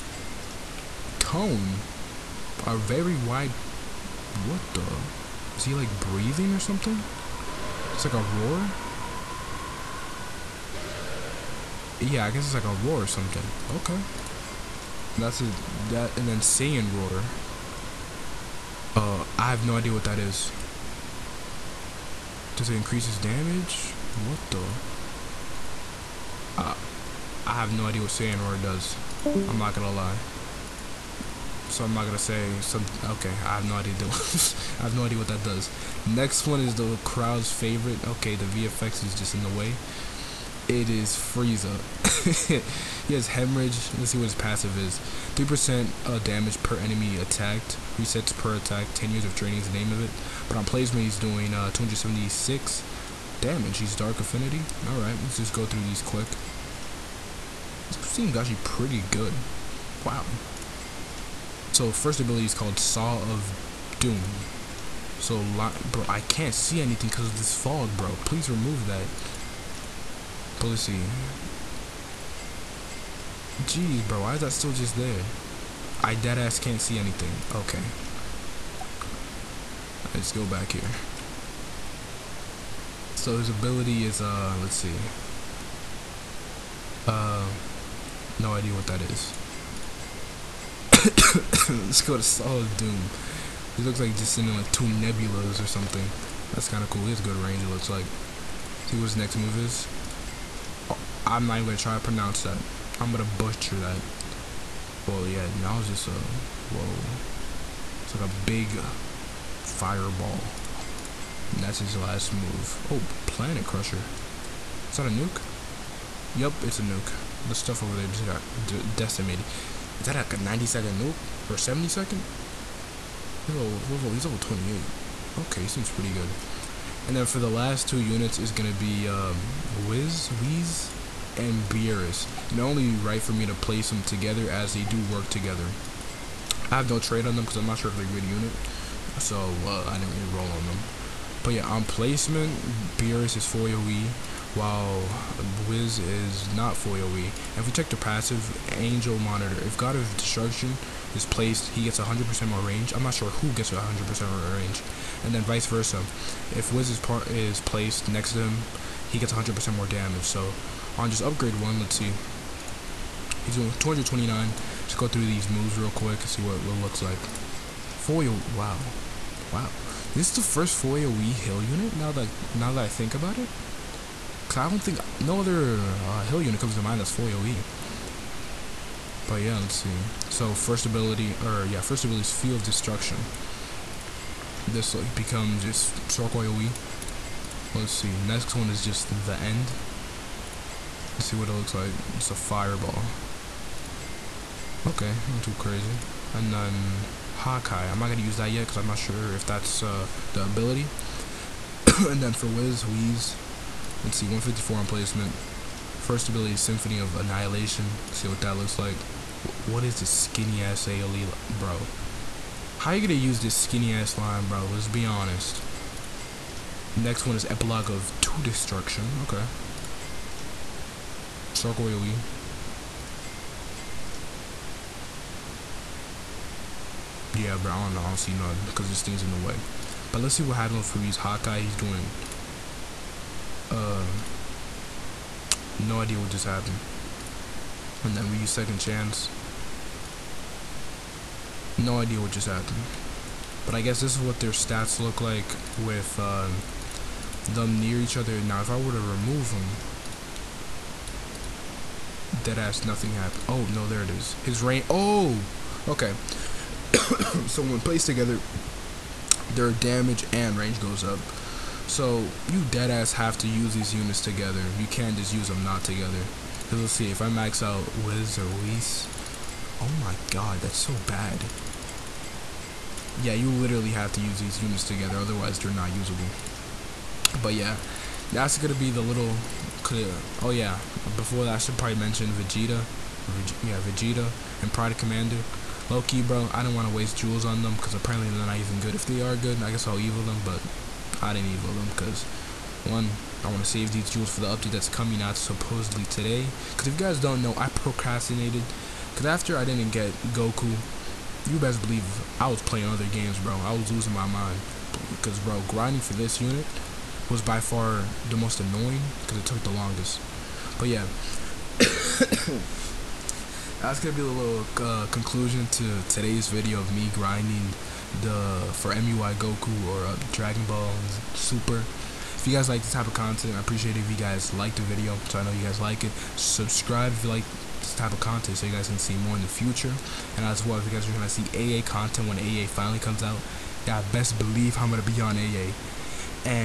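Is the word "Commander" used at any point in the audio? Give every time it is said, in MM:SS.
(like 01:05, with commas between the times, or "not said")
04:44.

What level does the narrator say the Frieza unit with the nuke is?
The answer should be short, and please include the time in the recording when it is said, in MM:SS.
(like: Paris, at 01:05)
28, at 02:04.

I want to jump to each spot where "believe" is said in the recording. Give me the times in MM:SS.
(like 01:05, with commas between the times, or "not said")
05:01, 05:34.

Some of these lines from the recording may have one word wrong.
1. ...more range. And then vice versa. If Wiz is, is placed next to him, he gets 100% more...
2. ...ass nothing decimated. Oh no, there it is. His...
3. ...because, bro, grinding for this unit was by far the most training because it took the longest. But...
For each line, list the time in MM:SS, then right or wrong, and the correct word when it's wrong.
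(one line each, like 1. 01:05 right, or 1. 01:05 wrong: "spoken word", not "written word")
1. 02:34 right
2. 04:12 wrong: "happened", not "decimated"
3. 05:05 wrong: "annoying", not "training".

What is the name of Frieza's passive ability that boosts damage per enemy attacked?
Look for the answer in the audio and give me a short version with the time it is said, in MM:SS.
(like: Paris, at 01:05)
10 Years of Training, at 00:48.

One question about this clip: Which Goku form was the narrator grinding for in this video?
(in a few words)
MUI.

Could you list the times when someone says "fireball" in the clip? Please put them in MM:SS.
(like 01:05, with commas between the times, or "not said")
01:49, 03:12.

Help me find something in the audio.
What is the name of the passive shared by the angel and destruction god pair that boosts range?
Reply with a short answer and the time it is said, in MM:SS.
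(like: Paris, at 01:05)
Angel Monitor, at 02:28.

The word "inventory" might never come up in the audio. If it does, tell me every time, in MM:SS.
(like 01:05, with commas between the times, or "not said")
not said.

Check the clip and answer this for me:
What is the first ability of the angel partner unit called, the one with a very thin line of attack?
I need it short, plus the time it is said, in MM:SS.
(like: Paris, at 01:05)
Symphony of Annihilation, at 03:26.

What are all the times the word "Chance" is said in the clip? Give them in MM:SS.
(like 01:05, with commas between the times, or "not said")
03:58.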